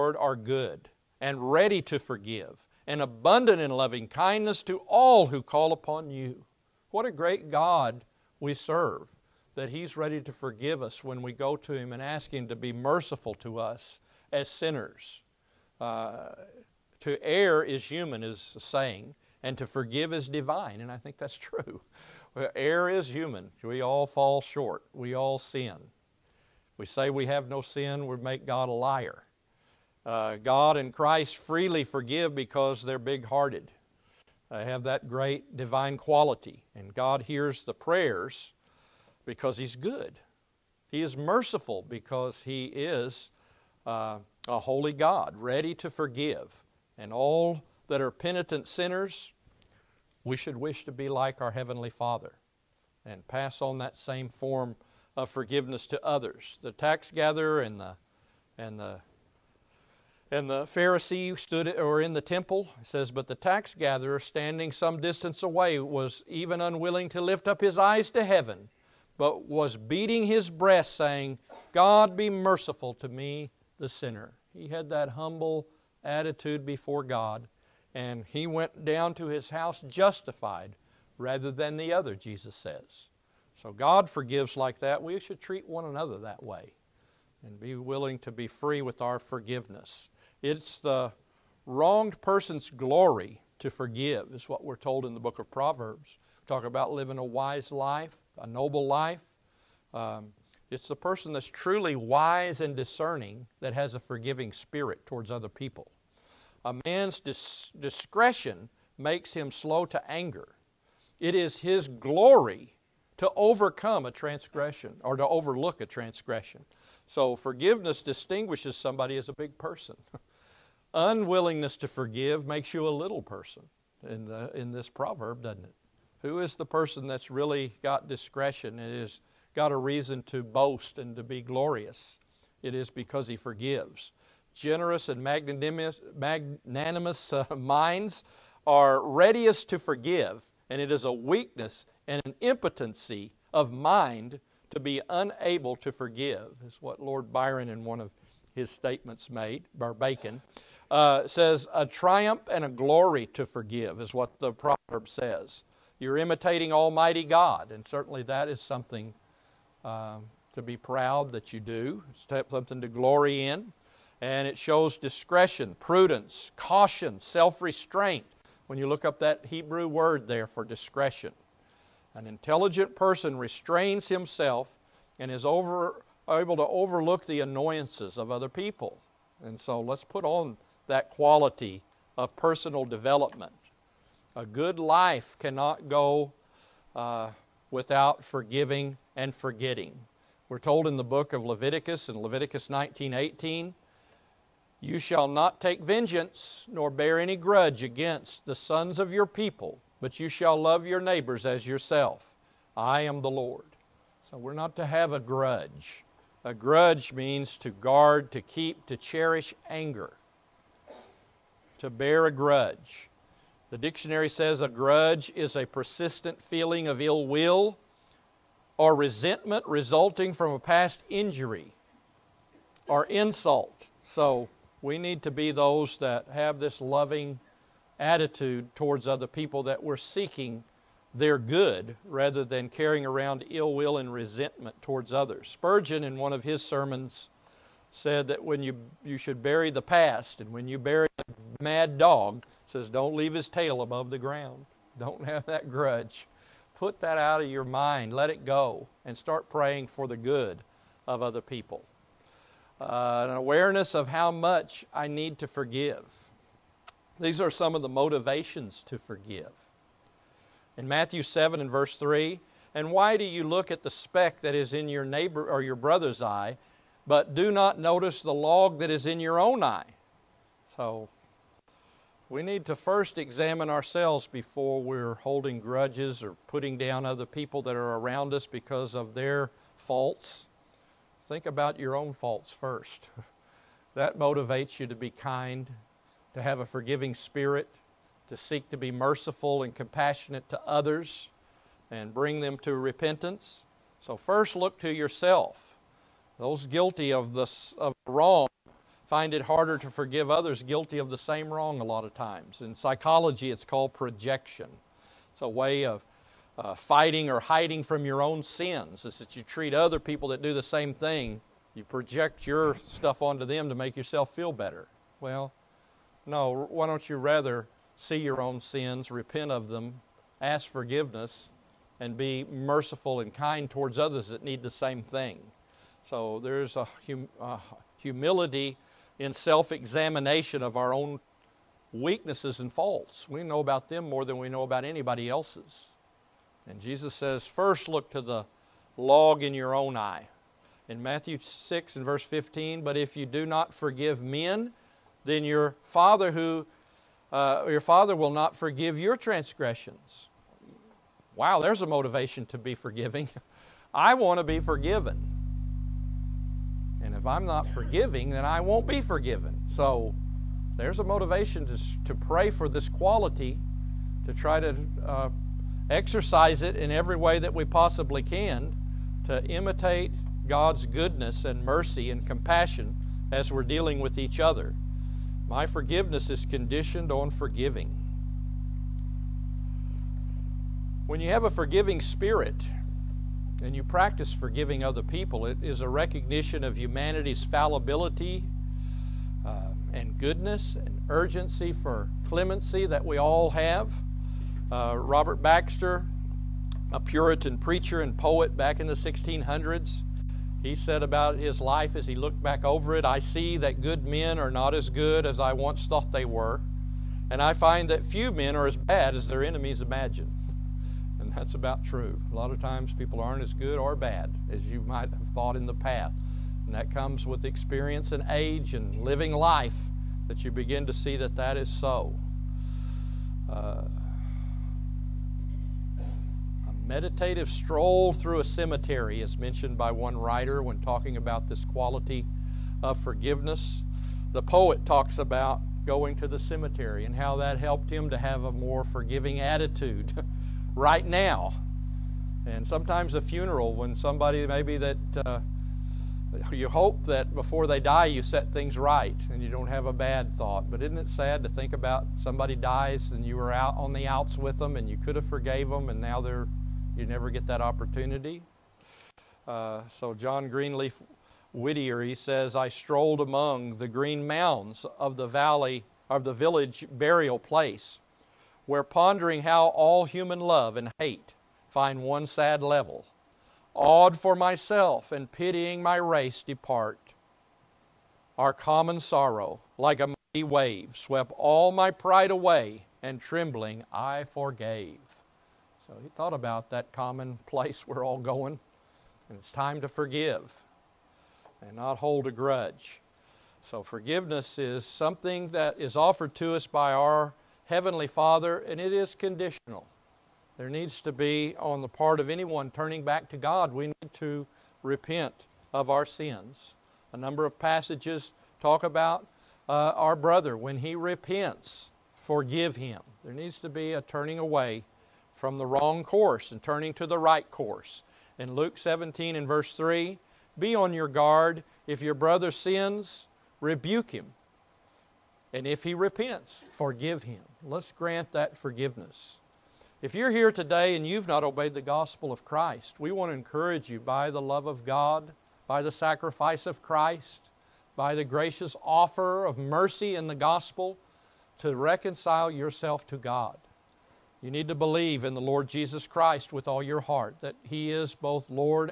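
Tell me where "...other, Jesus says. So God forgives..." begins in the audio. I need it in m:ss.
1:21.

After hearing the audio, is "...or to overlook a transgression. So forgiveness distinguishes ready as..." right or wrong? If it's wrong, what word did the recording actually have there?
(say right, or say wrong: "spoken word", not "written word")
wrong: "somebody", not "ready".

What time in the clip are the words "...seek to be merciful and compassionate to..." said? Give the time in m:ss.
4:48.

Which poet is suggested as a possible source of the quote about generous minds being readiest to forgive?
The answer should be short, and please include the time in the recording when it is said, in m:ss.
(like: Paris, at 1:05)
Lord Byron, at 2:26.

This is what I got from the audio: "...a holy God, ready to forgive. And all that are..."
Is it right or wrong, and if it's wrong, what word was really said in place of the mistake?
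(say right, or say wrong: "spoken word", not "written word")
right.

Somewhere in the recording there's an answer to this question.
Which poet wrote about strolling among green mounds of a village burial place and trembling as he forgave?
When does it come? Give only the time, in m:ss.
7:40.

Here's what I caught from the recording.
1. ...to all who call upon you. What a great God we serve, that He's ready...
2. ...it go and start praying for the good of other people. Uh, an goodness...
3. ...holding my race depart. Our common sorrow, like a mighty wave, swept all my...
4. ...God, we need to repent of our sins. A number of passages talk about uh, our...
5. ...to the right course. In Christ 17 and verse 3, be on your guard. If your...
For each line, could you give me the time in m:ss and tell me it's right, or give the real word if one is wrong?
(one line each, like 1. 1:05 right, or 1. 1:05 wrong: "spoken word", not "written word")
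1. 0:04 right
2. 4:08 wrong: "awareness", not "goodness"
3. 7:55 wrong: "pitying", not "holding"
4. 8:23 right
5. 8:36 wrong: "Luke", not "Christ".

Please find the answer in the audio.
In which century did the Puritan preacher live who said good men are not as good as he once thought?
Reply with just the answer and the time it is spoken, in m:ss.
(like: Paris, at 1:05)
1600s, at 6:38.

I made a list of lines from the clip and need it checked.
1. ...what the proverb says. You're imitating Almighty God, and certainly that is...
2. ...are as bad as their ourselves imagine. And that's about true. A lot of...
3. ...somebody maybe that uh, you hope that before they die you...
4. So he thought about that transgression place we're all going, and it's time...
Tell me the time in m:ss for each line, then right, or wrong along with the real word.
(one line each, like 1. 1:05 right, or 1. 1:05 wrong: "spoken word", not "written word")
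1. 2:34 right
2. 6:48 wrong: "enemies", not "ourselves"
3. 7:23 right
4. 8:05 wrong: "common", not "transgression".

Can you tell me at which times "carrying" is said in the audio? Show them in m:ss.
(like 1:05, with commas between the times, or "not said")
3:52.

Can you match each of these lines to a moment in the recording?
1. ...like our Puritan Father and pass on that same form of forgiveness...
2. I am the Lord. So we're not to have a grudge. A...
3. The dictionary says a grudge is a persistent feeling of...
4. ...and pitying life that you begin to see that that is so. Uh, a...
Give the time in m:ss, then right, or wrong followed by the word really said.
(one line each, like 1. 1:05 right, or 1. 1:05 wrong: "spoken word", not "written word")
1. 0:51 wrong: "Heavenly", not "Puritan"
2. 3:22 right
3. 3:33 right
4. 6:58 wrong: "living", not "pitying".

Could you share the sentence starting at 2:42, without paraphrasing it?
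It's something to glory in, and it shows discretion, prudence, caution, self restraint.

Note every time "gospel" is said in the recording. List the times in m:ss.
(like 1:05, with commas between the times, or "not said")
8:51, 9:00.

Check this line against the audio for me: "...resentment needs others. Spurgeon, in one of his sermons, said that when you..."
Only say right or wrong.
wrong.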